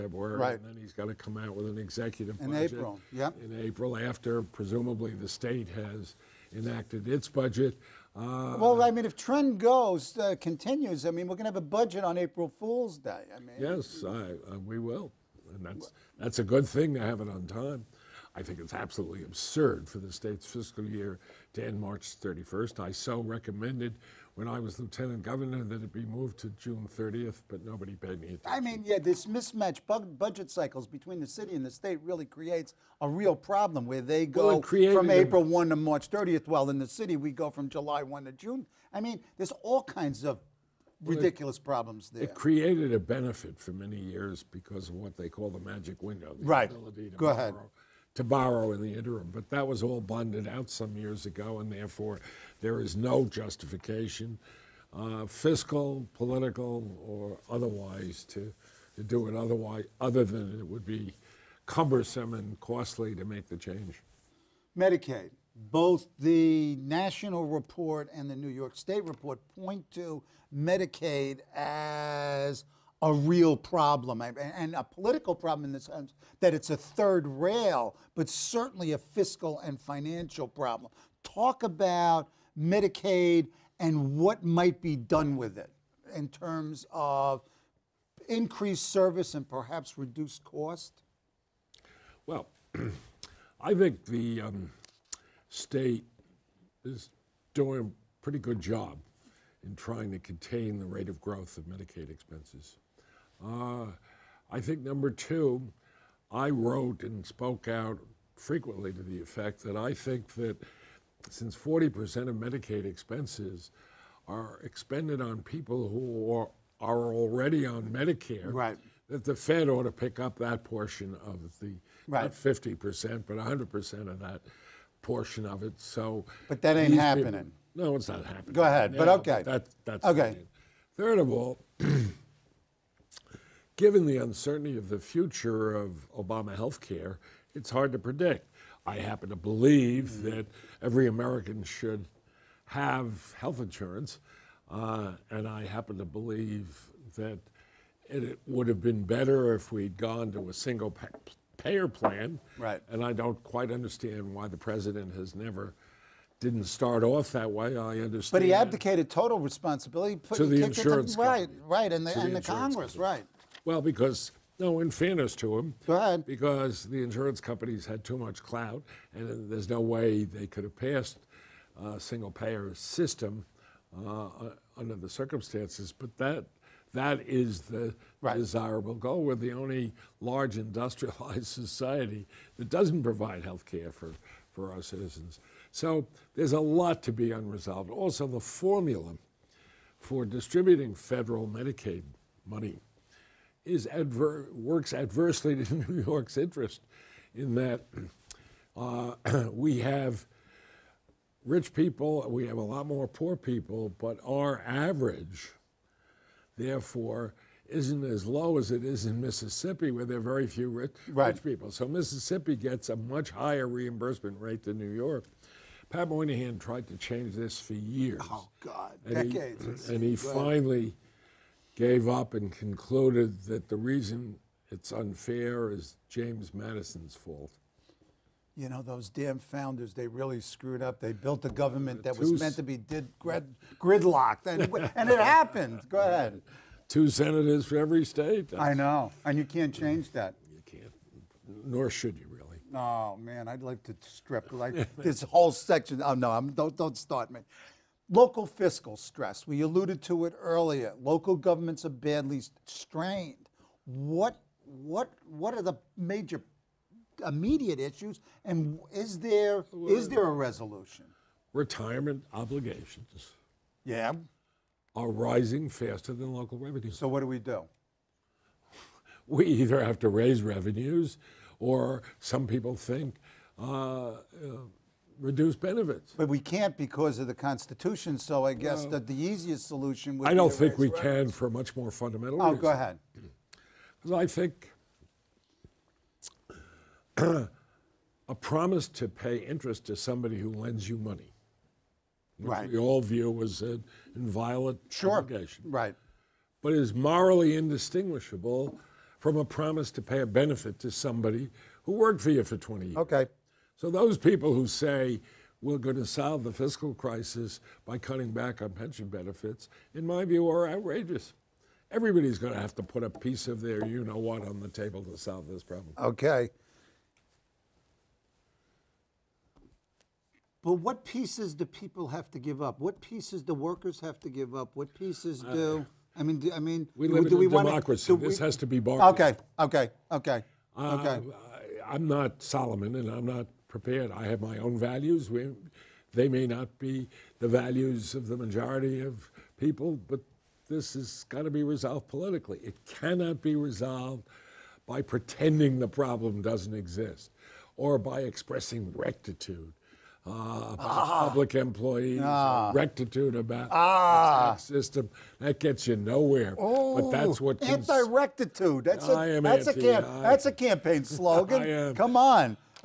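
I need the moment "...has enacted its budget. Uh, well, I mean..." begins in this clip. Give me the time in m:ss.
0:05.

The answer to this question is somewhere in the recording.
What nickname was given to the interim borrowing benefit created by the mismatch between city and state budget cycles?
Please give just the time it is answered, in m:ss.
0:45.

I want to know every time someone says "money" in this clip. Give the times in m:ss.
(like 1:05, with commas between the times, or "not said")
3:12, 4:50.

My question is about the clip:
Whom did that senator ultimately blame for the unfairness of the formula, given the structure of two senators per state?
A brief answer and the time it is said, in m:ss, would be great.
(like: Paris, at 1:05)
James Madison, at 3:46.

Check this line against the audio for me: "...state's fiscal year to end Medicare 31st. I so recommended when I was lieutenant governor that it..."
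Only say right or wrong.
wrong.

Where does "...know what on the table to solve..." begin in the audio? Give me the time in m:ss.
5:14.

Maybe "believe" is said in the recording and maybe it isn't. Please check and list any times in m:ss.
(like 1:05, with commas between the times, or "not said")
2:19, 2:26.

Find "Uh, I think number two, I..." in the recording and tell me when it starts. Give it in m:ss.
1:43.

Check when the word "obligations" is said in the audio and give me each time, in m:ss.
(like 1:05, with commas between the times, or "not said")
4:22, 4:55.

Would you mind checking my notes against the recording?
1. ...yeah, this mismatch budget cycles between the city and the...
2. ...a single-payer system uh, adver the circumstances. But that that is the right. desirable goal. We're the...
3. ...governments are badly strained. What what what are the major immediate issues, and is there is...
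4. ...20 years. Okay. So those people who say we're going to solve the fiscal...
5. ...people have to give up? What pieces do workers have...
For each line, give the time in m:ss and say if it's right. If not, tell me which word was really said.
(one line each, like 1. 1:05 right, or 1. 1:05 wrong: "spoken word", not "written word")
1. 0:28 right
2. 2:51 wrong: "under", not "adver"
3. 4:11 right
4. 5:02 right
5. 5:21 right.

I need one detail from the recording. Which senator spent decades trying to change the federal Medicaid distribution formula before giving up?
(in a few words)
Pat Moynihan.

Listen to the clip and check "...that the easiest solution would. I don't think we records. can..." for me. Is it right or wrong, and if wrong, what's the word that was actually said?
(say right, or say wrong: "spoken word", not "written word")
right.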